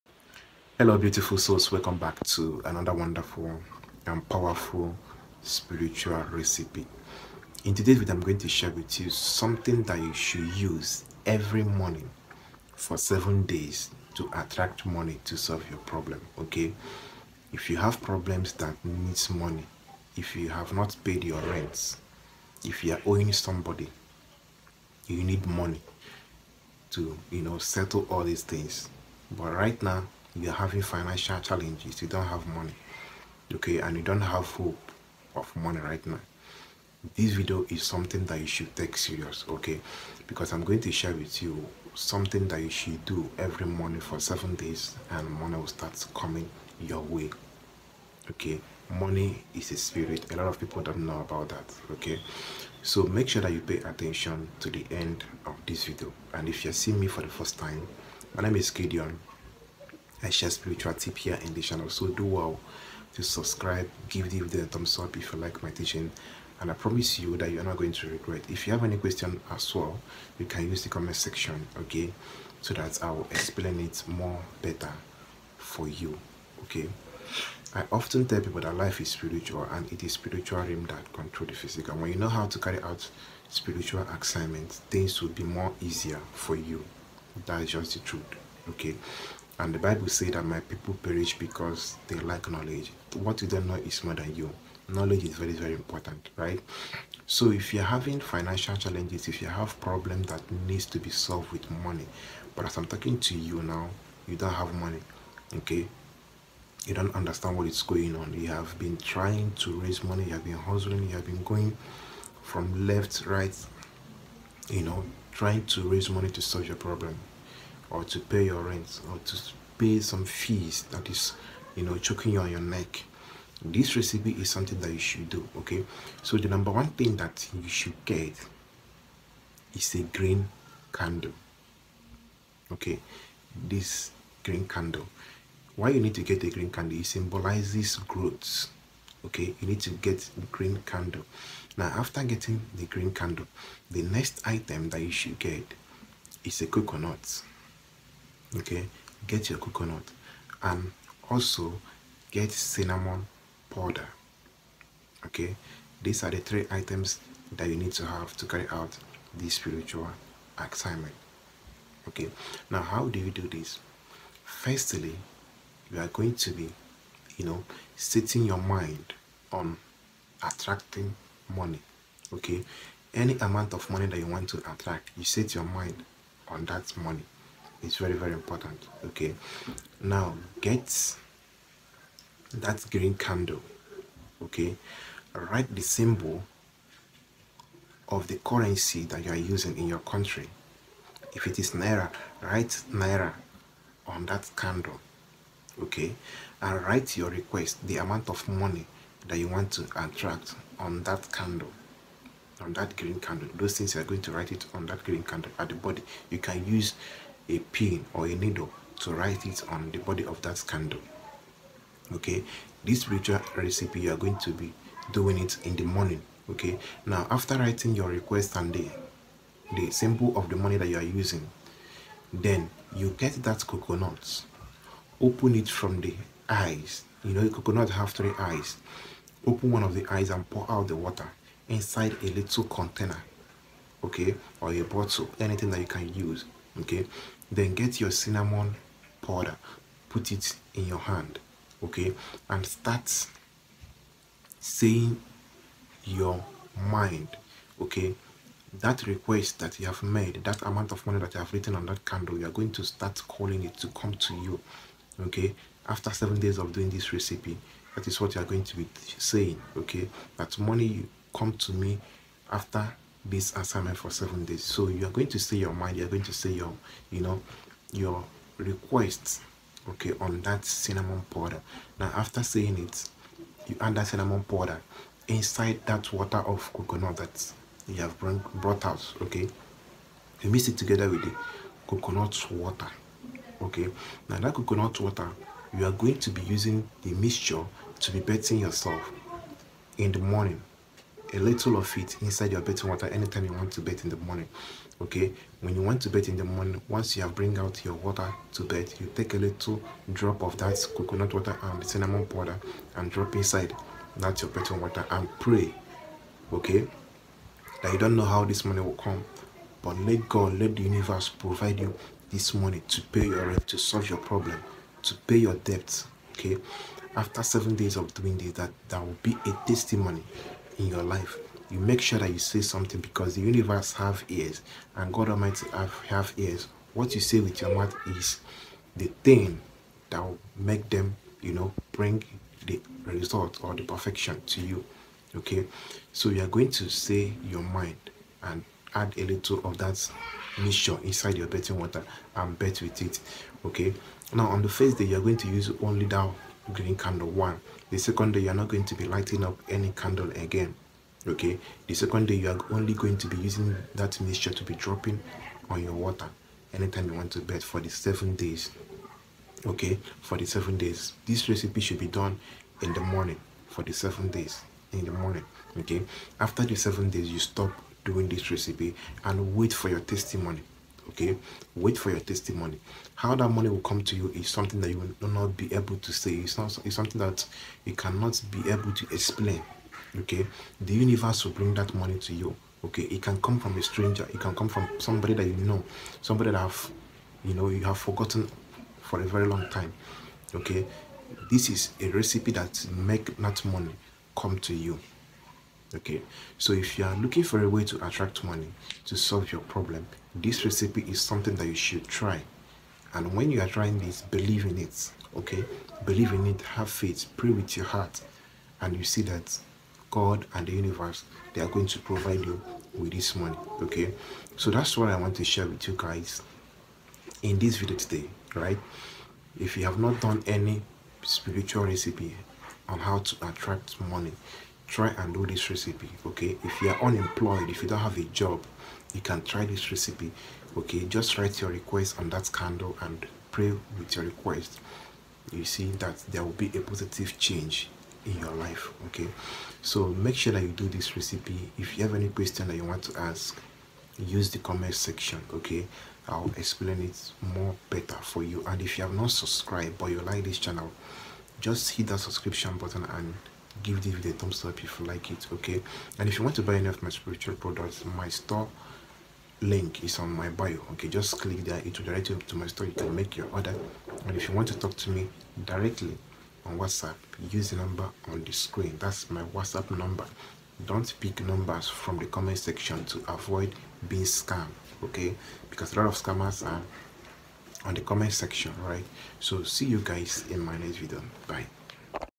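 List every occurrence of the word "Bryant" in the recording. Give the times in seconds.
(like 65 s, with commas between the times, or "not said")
not said.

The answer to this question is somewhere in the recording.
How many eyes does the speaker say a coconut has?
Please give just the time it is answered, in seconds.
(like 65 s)
228 s.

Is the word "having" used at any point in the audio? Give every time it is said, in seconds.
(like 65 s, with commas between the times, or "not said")
30 s, 97 s.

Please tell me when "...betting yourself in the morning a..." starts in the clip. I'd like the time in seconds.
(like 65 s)
288 s.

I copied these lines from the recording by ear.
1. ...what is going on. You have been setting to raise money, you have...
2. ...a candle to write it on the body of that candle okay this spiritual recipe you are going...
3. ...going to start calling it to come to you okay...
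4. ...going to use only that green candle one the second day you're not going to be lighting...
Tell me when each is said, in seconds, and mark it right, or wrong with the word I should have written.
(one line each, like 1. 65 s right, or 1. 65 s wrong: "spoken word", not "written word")
1. 107 s wrong: "trying", not "setting"
2. 208 s wrong: "needle", not "candle"
3. 252 s right
4. 345 s right.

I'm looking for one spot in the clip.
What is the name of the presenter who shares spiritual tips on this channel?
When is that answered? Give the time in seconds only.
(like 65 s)
58 s.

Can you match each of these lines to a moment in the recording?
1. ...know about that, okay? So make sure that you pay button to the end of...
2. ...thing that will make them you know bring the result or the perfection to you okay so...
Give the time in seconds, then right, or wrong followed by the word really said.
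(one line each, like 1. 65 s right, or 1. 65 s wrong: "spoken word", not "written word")
1. 51 s wrong: "attention", not "button"
2. 329 s right.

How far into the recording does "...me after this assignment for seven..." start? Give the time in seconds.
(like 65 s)
261 s.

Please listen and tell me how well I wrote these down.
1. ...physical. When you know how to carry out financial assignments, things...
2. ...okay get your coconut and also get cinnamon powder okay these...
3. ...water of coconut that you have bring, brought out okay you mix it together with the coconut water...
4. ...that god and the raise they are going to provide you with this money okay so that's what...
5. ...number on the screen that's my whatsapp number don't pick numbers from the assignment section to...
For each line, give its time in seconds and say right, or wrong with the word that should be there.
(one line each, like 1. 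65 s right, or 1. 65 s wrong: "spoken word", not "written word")
1. 81 s wrong: "spiritual", not "financial"
2. 148 s right
3. 276 s right
4. 409 s wrong: "universe", not "raise"
5. 467 s wrong: "comment", not "assignment".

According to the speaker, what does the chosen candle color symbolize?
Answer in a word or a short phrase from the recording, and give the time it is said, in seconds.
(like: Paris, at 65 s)
Growth, at 138 s.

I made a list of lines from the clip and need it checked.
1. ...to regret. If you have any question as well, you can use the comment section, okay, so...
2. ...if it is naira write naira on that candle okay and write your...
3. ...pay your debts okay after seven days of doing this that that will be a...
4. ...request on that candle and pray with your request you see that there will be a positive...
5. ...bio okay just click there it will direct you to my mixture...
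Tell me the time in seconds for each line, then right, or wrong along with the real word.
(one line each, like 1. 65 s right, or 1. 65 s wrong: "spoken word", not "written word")
1. 67 s right
2. 191 s right
3. 315 s right
4. 431 s right
5. 460 s wrong: "store", not "mixture".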